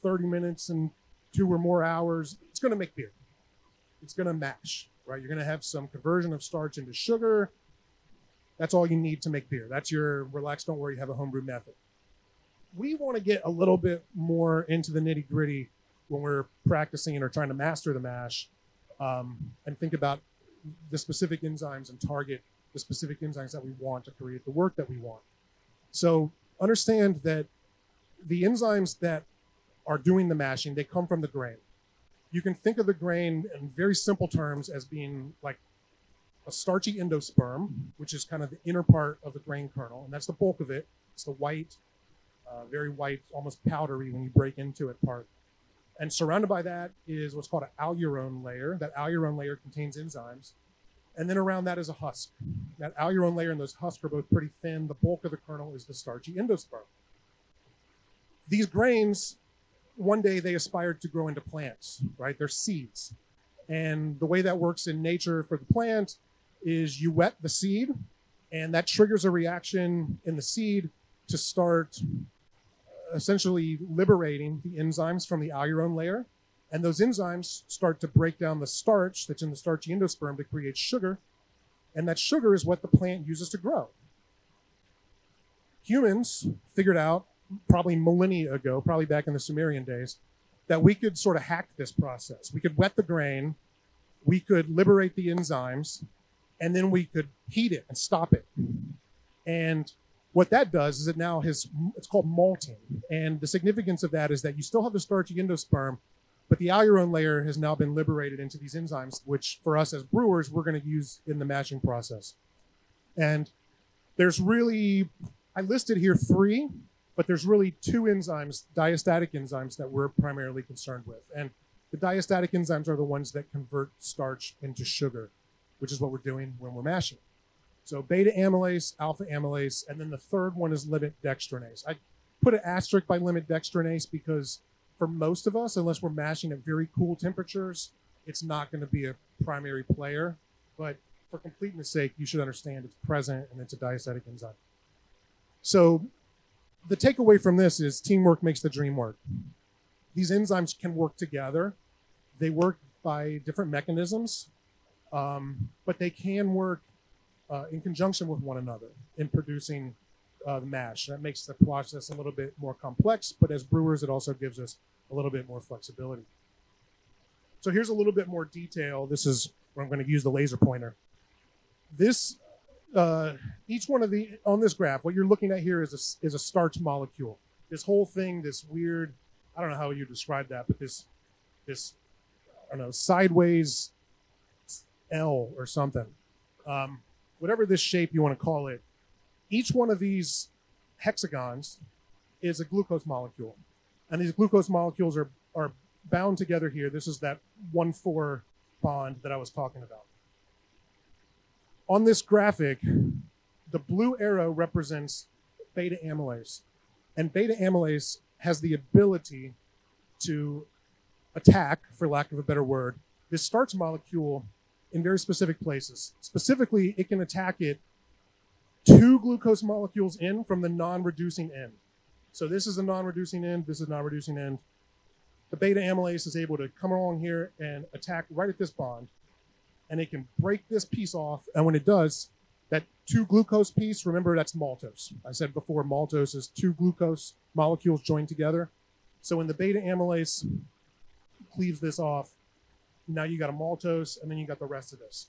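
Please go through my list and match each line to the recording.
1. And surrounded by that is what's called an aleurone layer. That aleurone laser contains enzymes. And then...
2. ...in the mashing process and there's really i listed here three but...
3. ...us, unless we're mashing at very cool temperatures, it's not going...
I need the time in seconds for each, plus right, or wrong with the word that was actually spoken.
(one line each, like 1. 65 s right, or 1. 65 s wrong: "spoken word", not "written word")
1. 45 s wrong: "layer", not "laser"
2. 111 s right
3. 135 s right.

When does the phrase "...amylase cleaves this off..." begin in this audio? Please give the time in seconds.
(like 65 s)
239 s.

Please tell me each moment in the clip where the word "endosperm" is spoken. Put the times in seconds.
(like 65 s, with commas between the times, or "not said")
36 s, 56 s, 79 s, 105 s.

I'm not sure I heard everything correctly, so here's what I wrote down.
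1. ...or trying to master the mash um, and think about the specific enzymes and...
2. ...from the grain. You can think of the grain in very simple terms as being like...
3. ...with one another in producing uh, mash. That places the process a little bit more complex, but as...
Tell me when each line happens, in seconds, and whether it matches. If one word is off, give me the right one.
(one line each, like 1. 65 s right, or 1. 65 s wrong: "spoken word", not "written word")
1. 17 s right
2. 31 s right
3. 158 s wrong: "makes", not "places".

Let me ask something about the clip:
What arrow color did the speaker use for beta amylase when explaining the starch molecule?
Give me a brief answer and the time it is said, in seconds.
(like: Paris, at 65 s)
blue, at 203 s.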